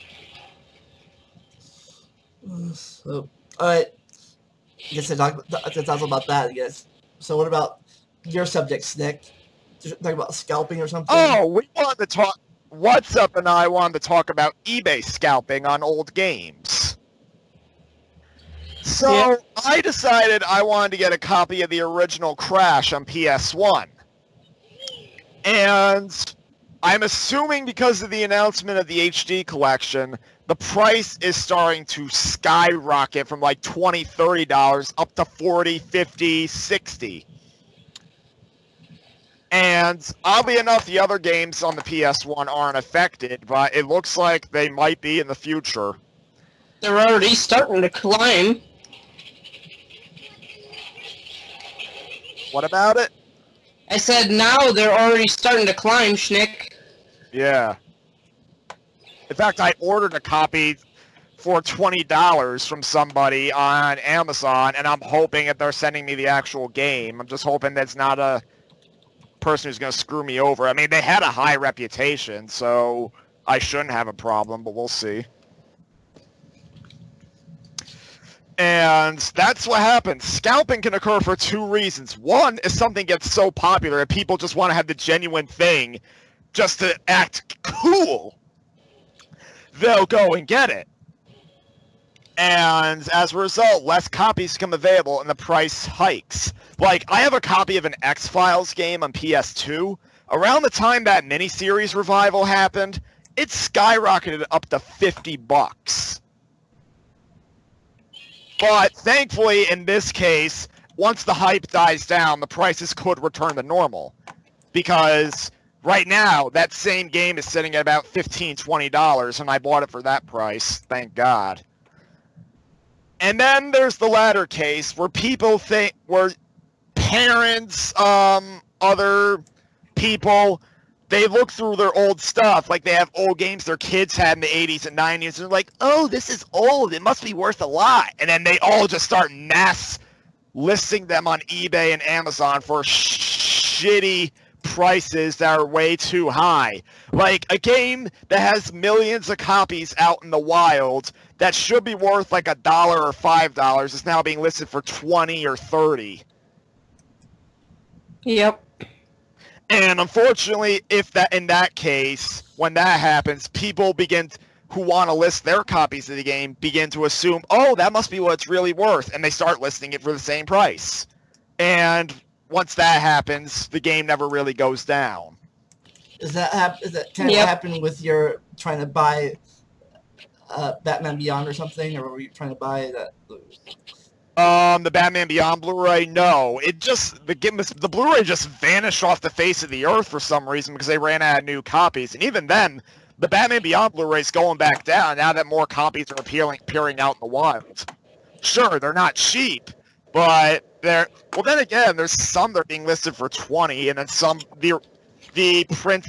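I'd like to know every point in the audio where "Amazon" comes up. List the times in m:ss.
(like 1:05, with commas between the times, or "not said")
1:03, 2:22.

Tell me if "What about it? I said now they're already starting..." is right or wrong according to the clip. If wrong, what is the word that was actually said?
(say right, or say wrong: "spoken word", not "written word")
right.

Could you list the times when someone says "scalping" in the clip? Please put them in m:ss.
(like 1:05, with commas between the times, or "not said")
0:10, 0:15, 1:20.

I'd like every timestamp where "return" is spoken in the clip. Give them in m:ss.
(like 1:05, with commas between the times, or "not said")
1:53.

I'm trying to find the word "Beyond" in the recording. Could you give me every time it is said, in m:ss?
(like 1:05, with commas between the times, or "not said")
3:01, 3:05, 3:13.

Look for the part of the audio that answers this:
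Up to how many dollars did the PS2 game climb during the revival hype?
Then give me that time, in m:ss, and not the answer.
1:44.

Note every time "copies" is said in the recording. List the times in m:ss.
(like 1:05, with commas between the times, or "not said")
1:34, 2:29, 2:45, 3:11, 3:15.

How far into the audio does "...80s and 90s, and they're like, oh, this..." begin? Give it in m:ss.
2:14.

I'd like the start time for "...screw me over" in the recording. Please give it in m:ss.
1:09.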